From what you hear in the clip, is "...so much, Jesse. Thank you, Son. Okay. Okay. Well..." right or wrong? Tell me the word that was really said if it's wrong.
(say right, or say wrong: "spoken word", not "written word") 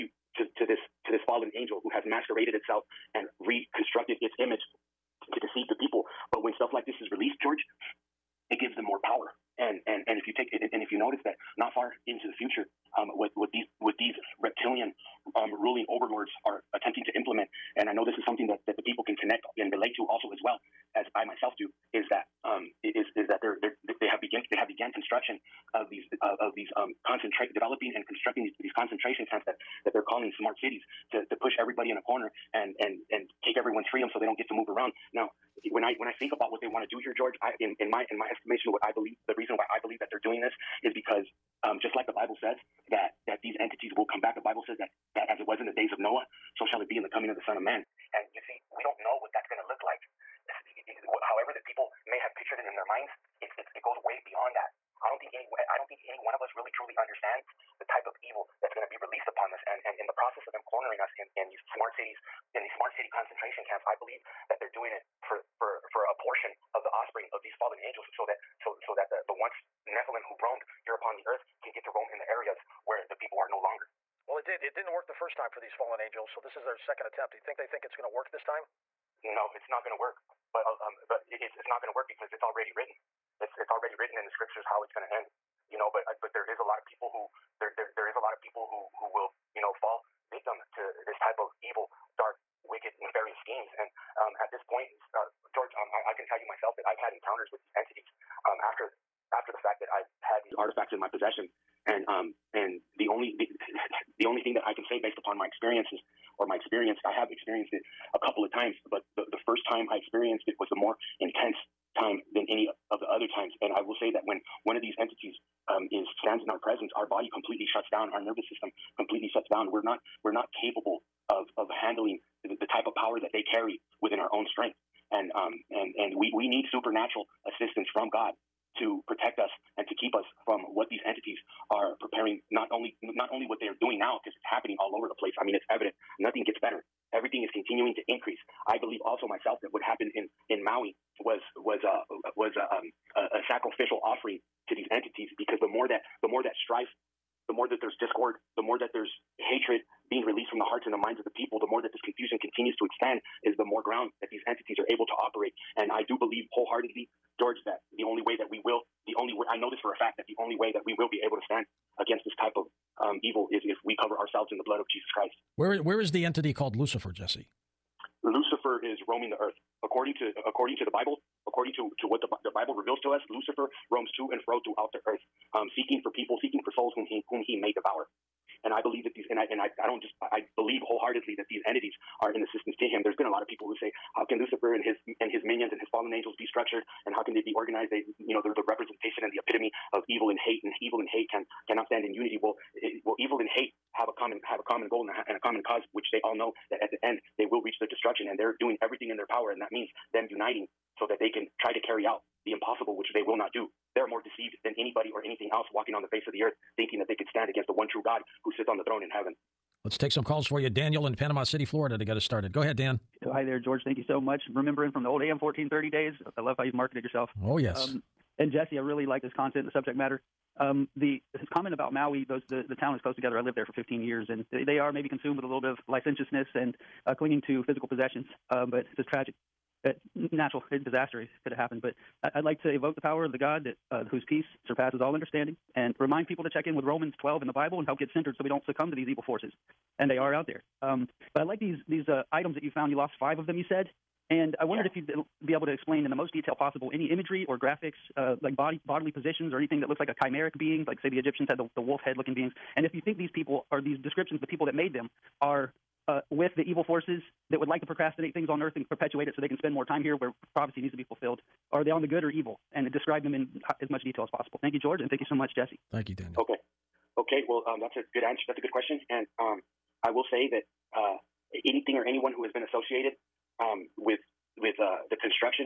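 wrong: "Daniel", not "Son".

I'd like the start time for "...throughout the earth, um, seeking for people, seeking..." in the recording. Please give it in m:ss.
2:54.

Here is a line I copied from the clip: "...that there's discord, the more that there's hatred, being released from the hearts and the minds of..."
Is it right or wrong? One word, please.
right.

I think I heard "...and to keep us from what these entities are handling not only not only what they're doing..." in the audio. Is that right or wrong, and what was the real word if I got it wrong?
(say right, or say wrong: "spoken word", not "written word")
wrong: "preparing", not "handling".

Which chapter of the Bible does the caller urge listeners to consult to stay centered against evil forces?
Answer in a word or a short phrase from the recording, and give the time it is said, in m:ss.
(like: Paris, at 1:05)
Romans 12, at 3:56.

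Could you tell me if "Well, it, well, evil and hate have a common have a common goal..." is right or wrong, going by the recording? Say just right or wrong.
right.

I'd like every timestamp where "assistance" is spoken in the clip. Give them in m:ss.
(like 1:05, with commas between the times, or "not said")
2:07, 3:02.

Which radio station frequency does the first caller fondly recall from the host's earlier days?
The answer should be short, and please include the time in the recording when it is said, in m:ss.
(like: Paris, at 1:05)
AM 1430, at 3:35.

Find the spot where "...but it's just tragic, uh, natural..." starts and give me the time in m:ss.
3:48.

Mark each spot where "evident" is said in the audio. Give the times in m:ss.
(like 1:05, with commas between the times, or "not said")
2:15.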